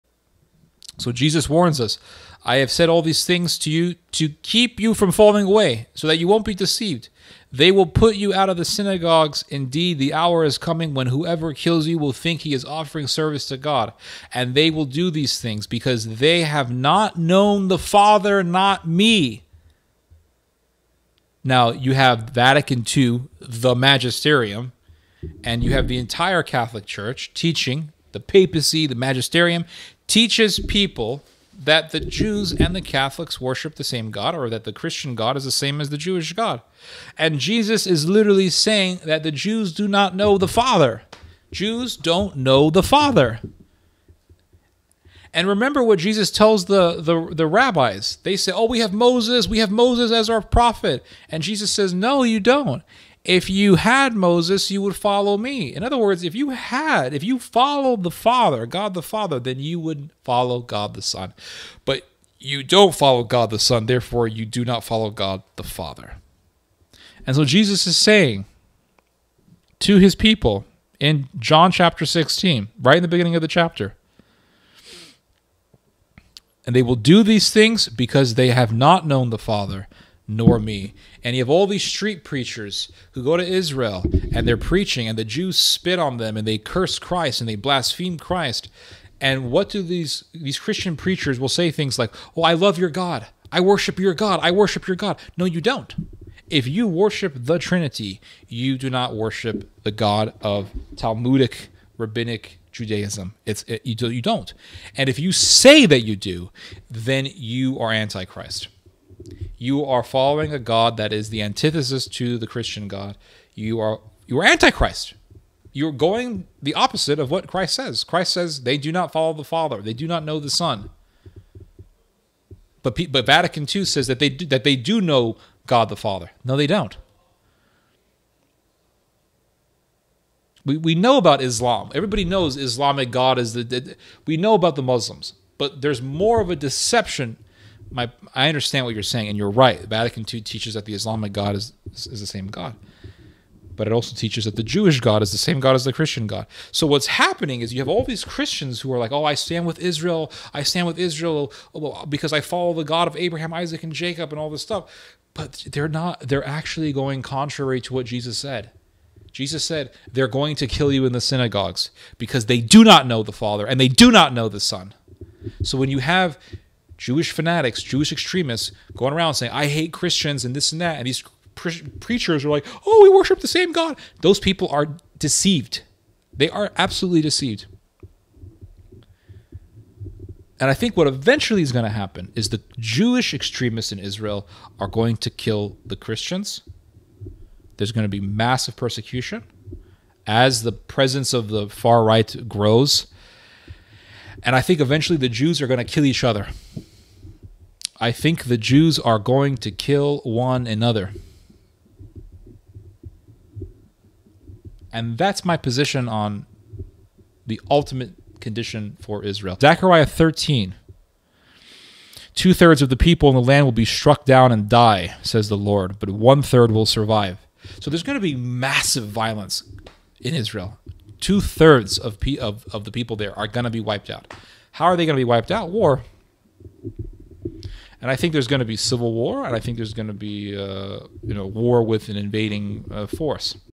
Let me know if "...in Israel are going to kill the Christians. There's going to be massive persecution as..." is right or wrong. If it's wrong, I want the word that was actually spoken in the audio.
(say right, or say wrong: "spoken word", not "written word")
right.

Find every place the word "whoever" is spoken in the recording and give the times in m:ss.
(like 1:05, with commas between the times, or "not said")
0:11.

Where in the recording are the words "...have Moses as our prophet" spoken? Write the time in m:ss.
0:49.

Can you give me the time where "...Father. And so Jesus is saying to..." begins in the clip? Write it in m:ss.
1:05.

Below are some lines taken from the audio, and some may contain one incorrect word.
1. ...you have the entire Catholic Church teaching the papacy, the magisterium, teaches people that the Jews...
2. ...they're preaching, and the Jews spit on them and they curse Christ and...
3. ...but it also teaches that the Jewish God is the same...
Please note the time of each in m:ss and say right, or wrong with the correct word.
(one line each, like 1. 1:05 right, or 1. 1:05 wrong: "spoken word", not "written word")
1. 0:25 right
2. 1:24 right
3. 2:23 right.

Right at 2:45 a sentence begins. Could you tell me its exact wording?
So when you have Jewish fanatics, Jewish extremists going around saying, I hate Christians and this and that.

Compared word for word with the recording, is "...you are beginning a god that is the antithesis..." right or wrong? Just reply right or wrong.
wrong.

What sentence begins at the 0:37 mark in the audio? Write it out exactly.
And Jesus is literally saying that the Jews do not know the Father.